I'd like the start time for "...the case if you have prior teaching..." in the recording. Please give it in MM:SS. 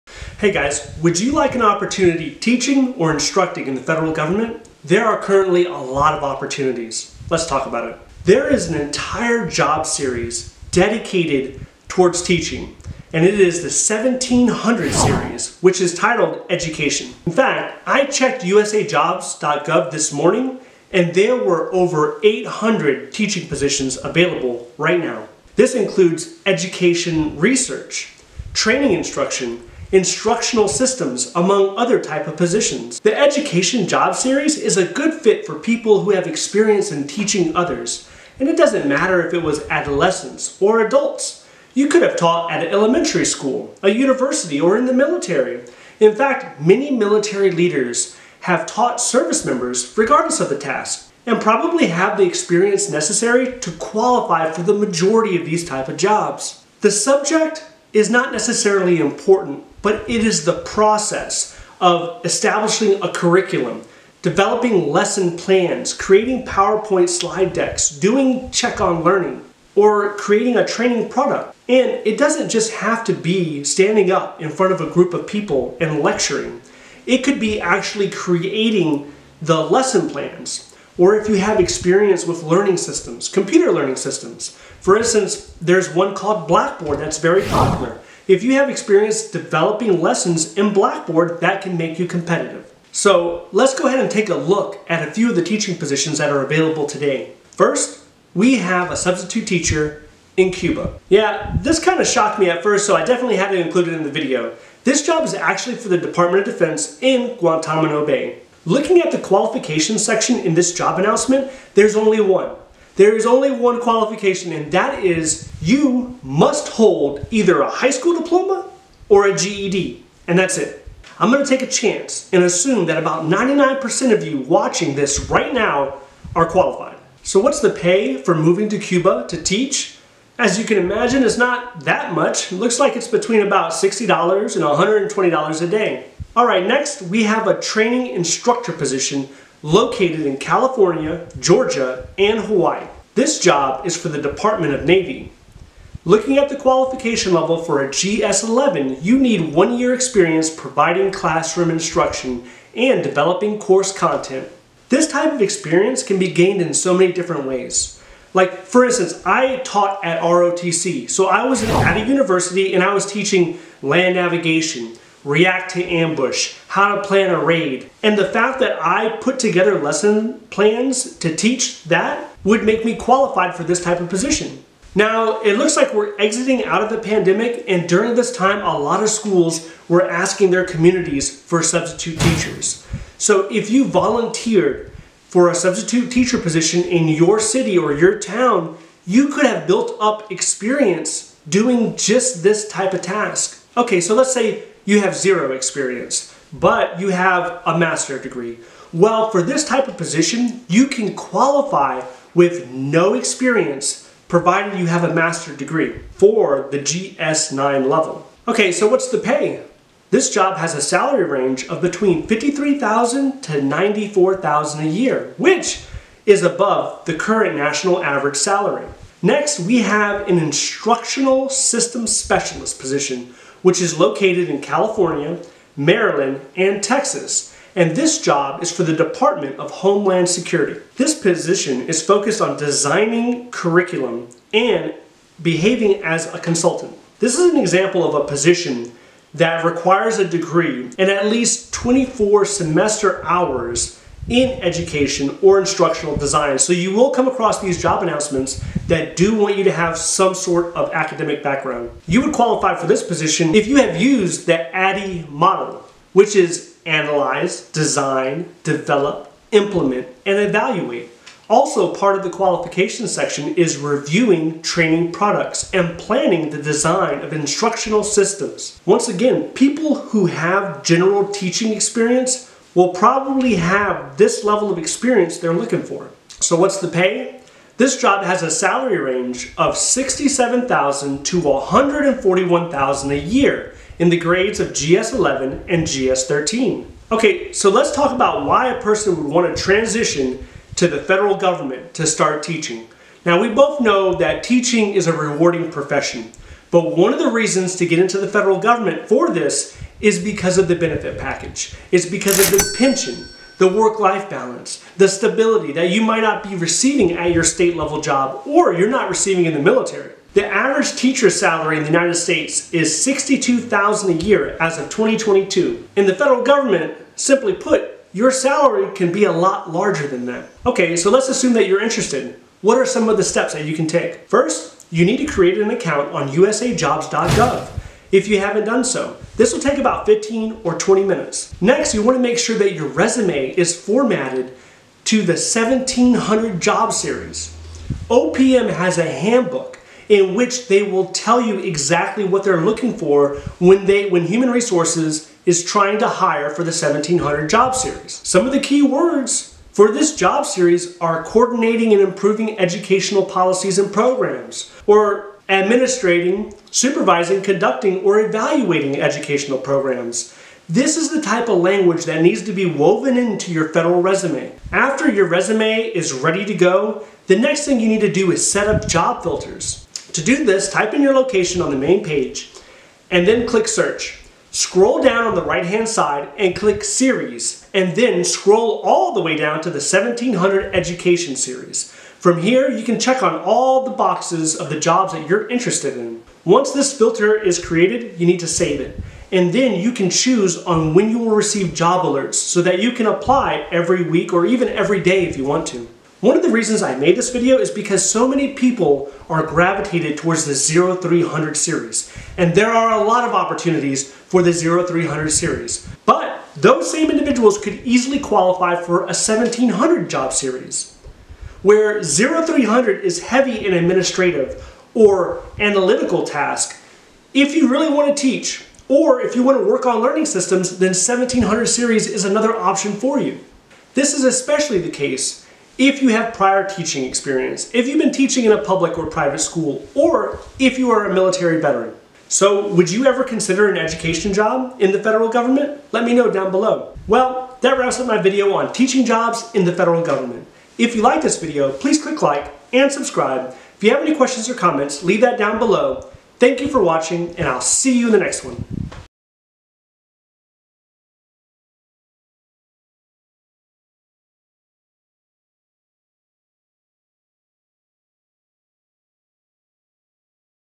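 07:04.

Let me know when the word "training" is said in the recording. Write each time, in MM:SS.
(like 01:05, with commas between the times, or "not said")
00:28, 01:10, 02:17, 04:24.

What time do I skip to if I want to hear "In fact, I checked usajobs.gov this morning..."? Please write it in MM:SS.
00:17.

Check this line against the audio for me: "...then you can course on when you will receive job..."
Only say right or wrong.
wrong.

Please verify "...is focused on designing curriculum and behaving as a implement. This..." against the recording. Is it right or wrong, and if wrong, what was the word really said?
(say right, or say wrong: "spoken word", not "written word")
wrong: "consultant", not "implement".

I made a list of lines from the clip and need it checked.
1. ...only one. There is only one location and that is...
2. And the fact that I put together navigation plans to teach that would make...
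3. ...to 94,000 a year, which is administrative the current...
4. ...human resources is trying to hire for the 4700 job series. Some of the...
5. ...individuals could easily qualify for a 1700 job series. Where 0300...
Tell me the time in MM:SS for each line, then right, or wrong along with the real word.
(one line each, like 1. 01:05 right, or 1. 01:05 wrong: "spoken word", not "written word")
1. 01:51 wrong: "qualification", not "location"
2. 02:48 wrong: "lesson", not "navigation"
3. 03:33 wrong: "above", not "administrative"
4. 05:44 wrong: "1700", not "4700"
5. 06:47 right.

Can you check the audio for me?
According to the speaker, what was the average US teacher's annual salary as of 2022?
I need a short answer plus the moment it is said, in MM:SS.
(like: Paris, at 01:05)
$62,000, at 05:13.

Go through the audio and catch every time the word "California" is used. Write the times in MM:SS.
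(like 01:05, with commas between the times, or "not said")
02:20, 03:44.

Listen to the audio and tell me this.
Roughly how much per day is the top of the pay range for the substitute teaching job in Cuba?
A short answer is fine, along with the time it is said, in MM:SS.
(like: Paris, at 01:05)
$120, at 02:15.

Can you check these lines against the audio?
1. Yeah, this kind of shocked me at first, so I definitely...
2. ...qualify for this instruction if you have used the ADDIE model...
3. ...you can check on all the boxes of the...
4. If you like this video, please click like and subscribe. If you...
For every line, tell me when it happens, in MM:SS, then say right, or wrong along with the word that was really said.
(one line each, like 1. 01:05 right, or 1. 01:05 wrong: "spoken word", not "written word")
1. 01:41 right
2. 04:12 wrong: "position", not "instruction"
3. 06:22 right
4. 07:20 right.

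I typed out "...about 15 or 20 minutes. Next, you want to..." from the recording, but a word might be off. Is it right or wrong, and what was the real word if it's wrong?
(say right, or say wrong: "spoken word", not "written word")
right.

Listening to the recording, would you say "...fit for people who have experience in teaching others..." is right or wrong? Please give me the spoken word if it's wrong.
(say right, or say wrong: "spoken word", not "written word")
right.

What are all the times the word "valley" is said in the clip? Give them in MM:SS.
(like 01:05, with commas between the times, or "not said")
not said.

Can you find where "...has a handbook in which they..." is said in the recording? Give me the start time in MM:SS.
05:38.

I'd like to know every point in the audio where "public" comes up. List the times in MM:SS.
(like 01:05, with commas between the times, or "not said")
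07:08.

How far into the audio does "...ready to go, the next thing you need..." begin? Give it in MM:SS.
06:06.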